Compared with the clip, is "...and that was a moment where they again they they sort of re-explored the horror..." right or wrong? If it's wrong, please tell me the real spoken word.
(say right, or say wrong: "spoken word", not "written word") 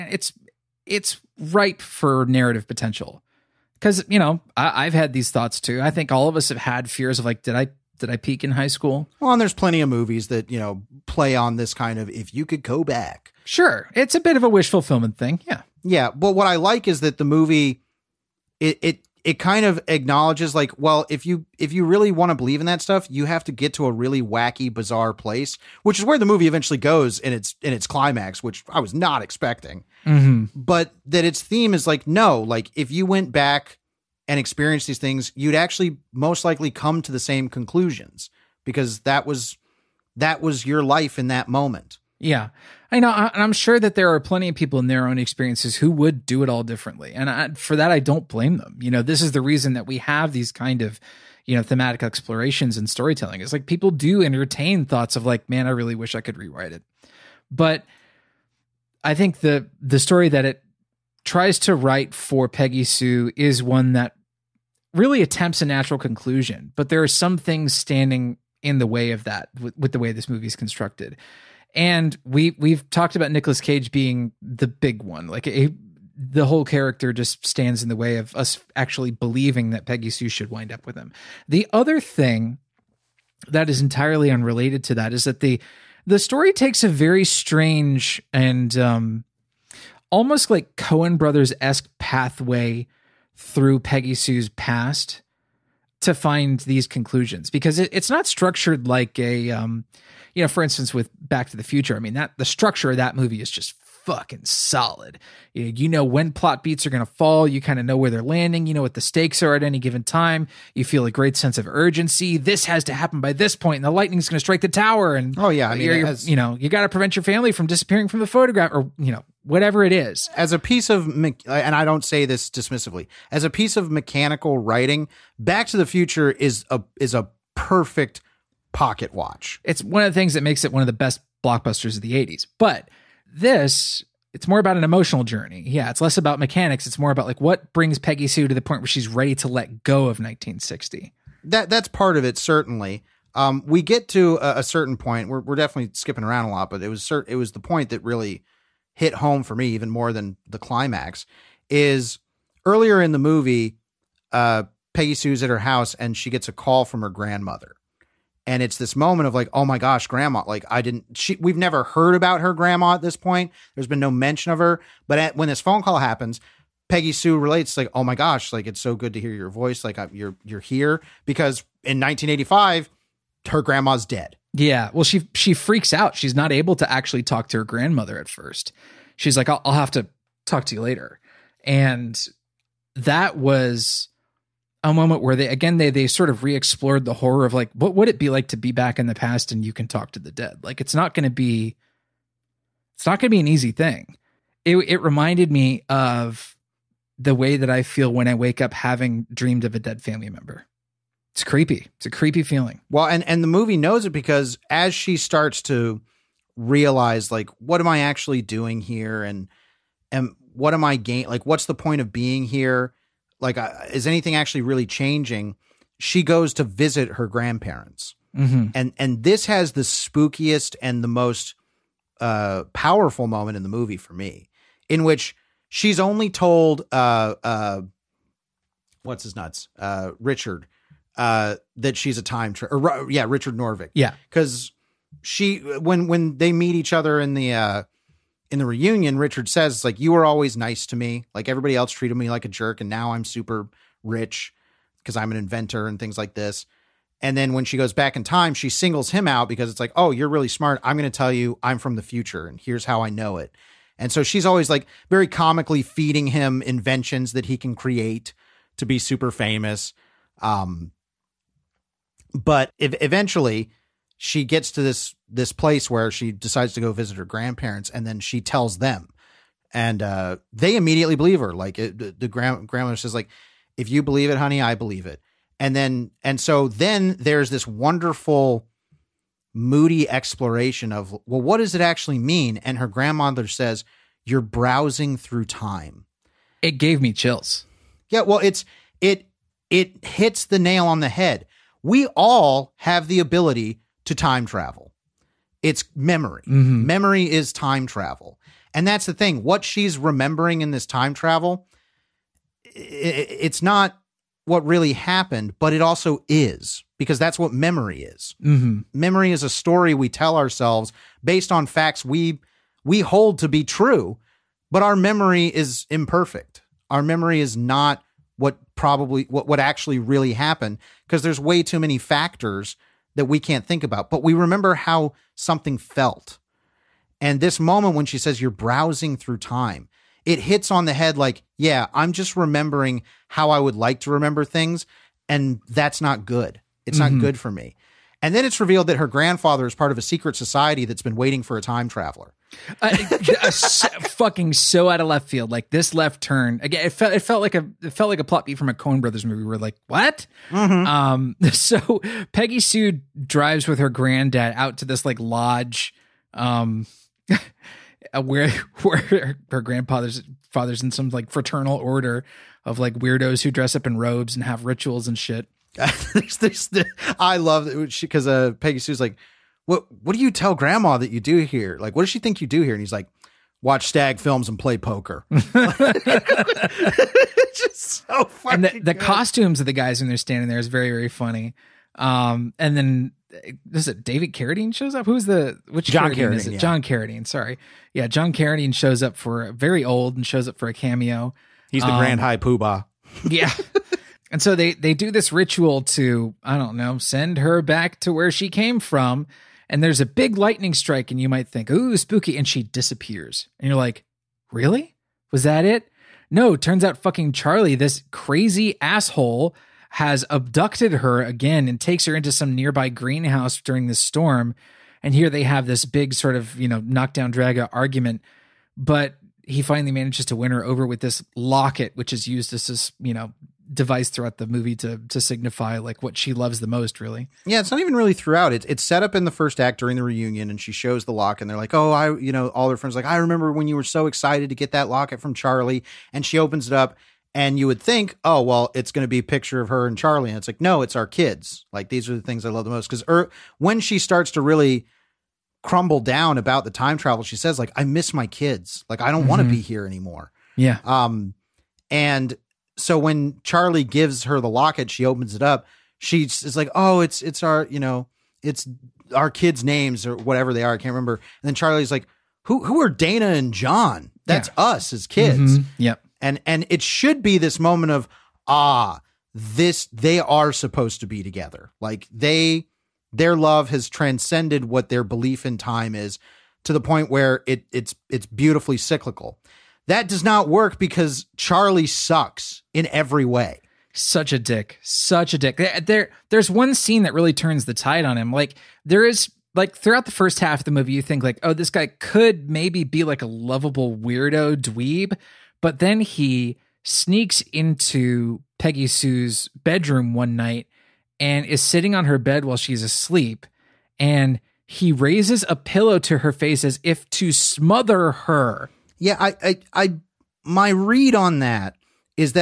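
right.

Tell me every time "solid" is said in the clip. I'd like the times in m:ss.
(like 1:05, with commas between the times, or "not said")
1:44.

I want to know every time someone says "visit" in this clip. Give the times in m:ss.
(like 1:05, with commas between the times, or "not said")
3:36, 4:26.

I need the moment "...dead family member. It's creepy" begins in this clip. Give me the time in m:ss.
3:19.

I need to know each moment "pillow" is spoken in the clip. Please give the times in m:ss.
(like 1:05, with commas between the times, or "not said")
8:25.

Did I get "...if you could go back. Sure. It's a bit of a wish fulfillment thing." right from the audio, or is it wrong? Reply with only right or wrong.
right.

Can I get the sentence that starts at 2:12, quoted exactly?
But this it's more about an emotional journey.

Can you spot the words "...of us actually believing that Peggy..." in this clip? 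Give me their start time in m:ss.
1:18.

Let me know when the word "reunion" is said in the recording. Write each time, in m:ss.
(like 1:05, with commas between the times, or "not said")
3:58, 7:10.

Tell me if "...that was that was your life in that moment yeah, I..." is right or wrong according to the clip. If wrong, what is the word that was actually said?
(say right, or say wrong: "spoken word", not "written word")
right.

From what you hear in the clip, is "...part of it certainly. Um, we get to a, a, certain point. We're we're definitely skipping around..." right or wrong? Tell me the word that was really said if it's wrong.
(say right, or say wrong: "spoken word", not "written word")
right.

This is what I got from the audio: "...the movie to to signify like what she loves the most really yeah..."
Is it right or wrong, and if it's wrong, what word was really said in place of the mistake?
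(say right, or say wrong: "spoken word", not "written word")
right.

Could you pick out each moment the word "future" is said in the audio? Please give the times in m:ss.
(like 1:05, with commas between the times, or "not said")
1:41, 2:05, 4:12.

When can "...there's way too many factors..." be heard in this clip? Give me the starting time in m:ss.
5:21.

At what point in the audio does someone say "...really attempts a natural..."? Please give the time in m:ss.
1:04.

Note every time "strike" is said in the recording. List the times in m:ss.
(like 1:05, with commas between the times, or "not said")
1:54, 6:40.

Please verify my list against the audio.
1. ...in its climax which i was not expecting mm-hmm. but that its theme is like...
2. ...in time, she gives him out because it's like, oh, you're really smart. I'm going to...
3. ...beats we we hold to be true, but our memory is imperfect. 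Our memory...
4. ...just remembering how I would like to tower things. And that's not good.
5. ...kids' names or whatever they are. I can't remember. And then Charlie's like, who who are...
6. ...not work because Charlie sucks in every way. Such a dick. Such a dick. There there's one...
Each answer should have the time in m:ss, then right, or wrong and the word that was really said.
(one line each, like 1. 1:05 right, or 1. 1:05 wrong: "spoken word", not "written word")
1. 0:27 right
2. 4:08 wrong: "singles", not "gives"
3. 5:11 wrong: "facts", not "beats"
4. 5:32 wrong: "remember", not "tower"
5. 7:39 right
6. 8:00 right.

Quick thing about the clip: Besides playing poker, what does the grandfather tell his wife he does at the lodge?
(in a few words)
watch stag films.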